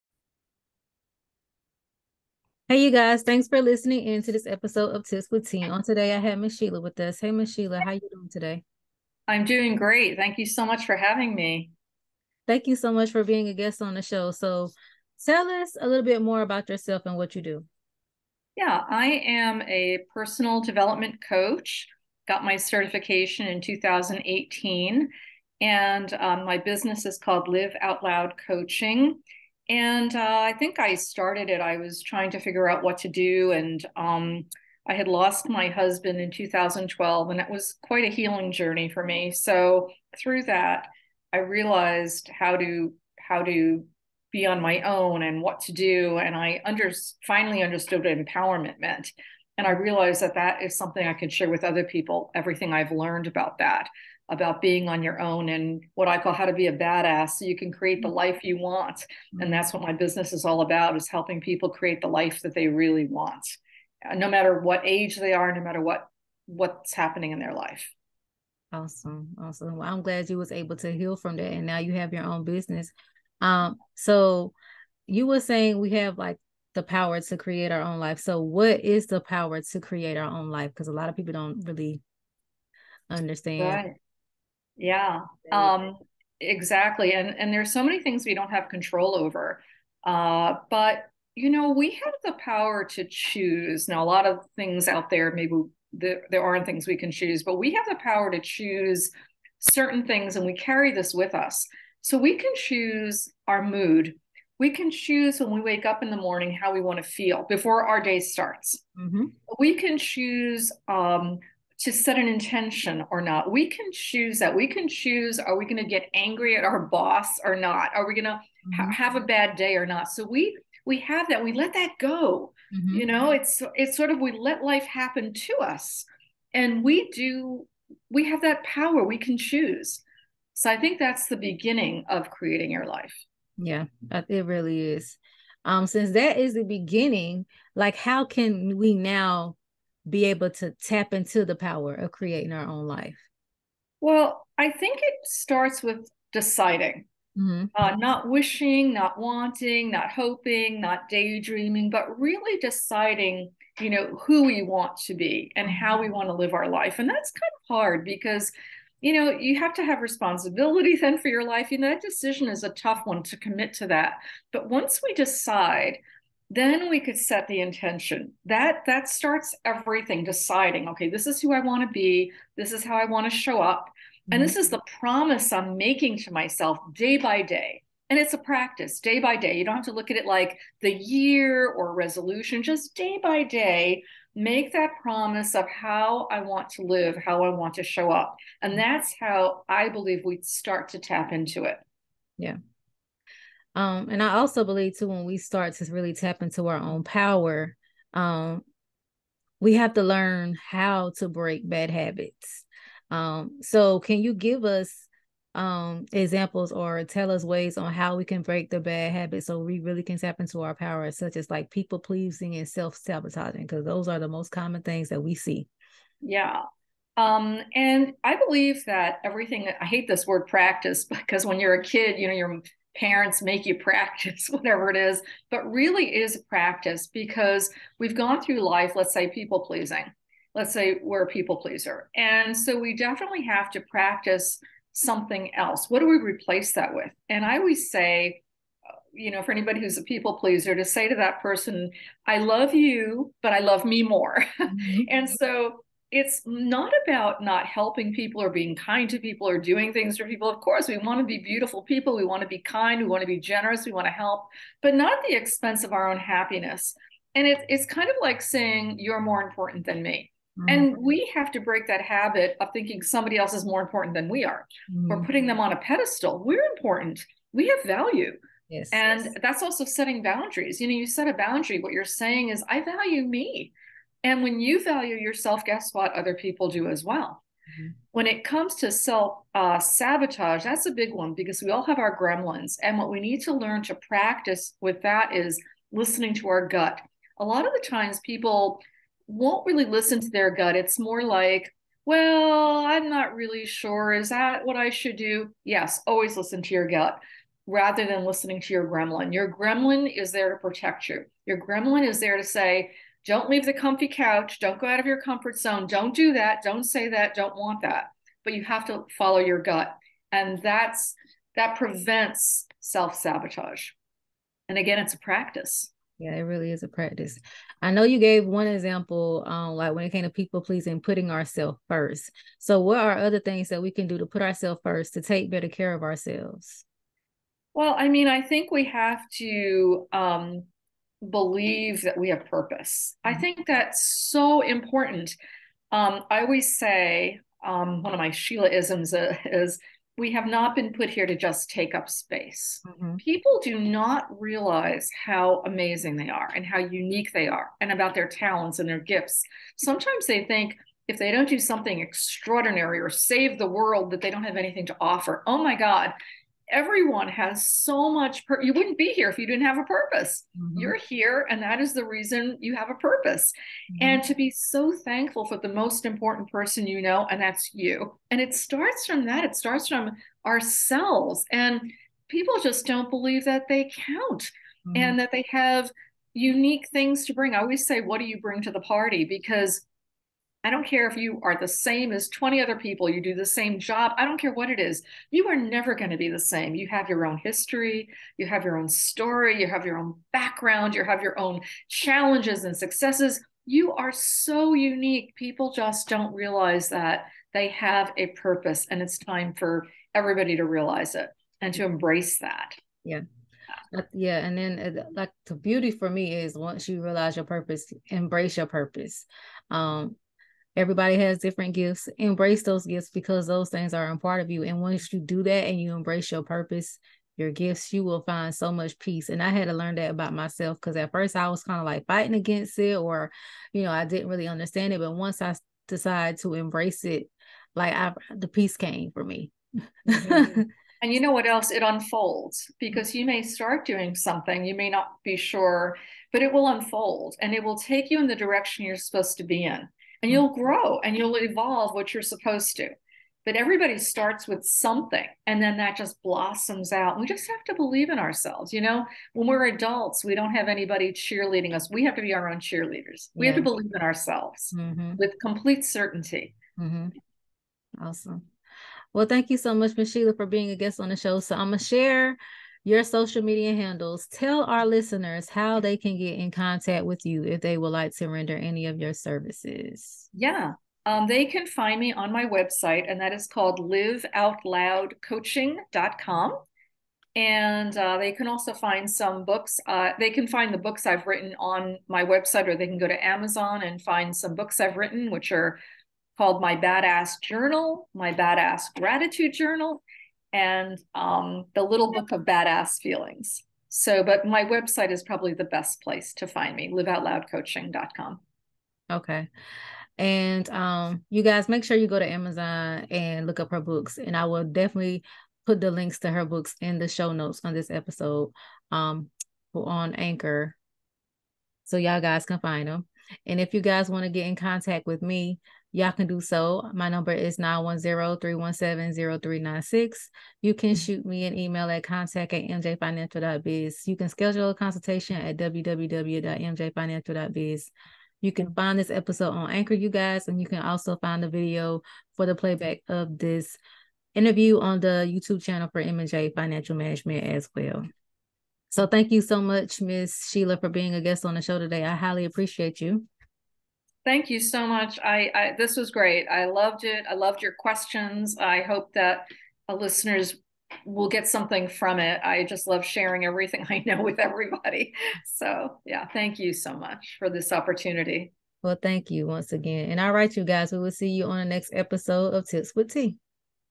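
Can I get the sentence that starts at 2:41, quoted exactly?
You know, that decision is a tough one to commit to that.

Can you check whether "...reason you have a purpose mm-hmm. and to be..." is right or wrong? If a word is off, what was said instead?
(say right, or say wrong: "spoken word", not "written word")
right.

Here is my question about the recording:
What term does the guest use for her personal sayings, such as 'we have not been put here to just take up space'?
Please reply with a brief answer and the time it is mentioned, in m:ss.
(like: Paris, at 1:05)
Sheila isms, at 5:38.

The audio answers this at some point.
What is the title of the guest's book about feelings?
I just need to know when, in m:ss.
8:11.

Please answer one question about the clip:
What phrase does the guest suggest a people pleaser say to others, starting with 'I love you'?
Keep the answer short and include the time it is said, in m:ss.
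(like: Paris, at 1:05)
but I love me more, at 4:03.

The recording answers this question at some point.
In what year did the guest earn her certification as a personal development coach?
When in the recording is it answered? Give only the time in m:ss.
0:23.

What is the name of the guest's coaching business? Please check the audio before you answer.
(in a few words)
Live Out Loud Coaching.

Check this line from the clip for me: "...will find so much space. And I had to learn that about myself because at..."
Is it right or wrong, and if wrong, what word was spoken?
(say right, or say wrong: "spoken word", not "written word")
wrong: "peace", not "space".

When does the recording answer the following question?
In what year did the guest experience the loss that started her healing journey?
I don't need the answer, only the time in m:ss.
0:36.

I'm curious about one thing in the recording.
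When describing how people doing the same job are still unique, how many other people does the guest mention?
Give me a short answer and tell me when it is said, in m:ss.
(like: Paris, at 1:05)
20, at 6:22.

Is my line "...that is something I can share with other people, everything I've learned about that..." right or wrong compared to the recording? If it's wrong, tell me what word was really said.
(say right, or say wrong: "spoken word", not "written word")
right.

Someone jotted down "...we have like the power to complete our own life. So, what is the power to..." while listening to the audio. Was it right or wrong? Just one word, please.
wrong.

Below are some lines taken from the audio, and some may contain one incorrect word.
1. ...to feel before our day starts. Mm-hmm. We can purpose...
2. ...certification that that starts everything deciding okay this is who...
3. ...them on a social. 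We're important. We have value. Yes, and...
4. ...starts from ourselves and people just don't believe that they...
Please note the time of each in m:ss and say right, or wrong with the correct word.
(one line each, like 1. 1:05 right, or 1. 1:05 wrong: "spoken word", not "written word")
1. 1:46 wrong: "choose", not "purpose"
2. 2:47 wrong: "intention", not "certification"
3. 4:25 wrong: "pedestal", not "social"
4. 6:09 right.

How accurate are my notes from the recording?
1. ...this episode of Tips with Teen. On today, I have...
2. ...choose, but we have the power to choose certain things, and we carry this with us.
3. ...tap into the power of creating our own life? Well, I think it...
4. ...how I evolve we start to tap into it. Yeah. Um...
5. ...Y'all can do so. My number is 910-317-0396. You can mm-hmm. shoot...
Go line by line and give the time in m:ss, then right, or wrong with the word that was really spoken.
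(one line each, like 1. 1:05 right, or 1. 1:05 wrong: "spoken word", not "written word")
1. 0:04 right
2. 1:37 right
3. 2:20 right
4. 3:09 wrong: "believe", not "evolve"
5. 8:35 right.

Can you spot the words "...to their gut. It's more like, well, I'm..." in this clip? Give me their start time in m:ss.
4:50.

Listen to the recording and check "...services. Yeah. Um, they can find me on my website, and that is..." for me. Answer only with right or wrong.
right.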